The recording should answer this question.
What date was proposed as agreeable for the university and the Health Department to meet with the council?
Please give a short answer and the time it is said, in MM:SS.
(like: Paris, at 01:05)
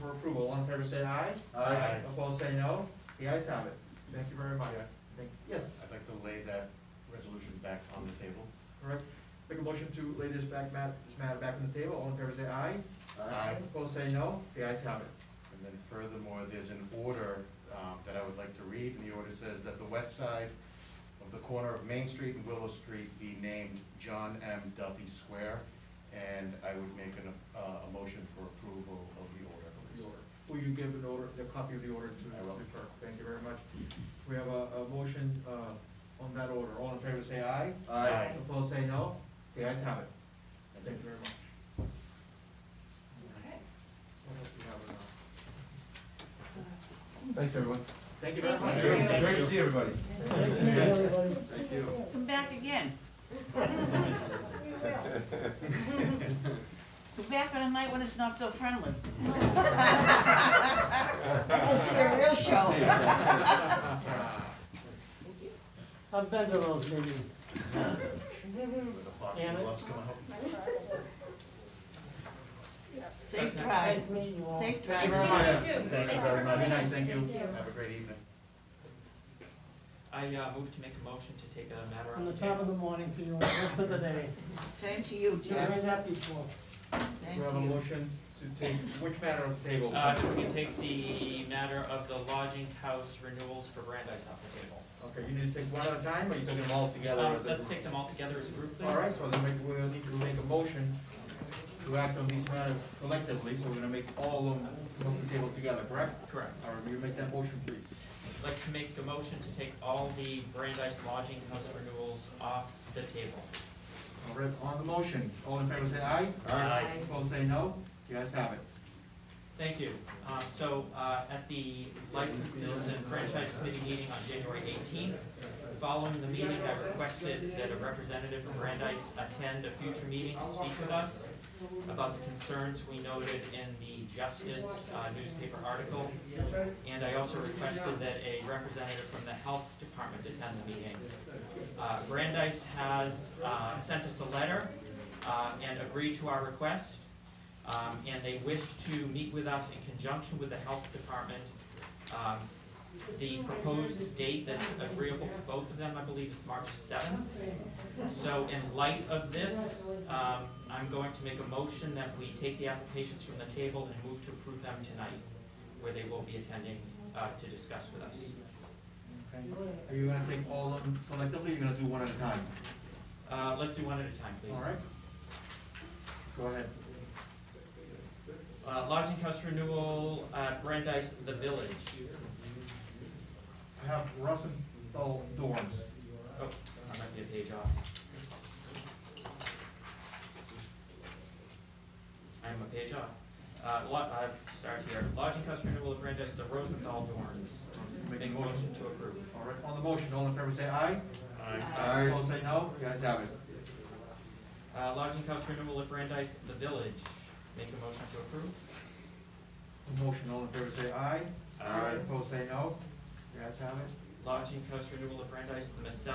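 March 7th, at 02:36.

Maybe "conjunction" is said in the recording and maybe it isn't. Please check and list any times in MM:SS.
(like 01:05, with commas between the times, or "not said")
02:29.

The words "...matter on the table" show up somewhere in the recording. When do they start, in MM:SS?
01:29.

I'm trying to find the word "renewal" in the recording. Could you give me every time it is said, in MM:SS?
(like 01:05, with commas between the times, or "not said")
01:33, 01:51, 02:59, 03:25, 03:34.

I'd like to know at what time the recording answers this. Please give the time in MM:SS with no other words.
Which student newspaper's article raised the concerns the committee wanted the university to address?
02:14.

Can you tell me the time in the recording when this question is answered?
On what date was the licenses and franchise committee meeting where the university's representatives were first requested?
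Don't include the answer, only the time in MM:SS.
02:04.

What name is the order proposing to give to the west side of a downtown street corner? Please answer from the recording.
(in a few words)
John M. Duffy Square.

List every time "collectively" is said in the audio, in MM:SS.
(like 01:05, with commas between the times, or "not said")
01:43, 02:51.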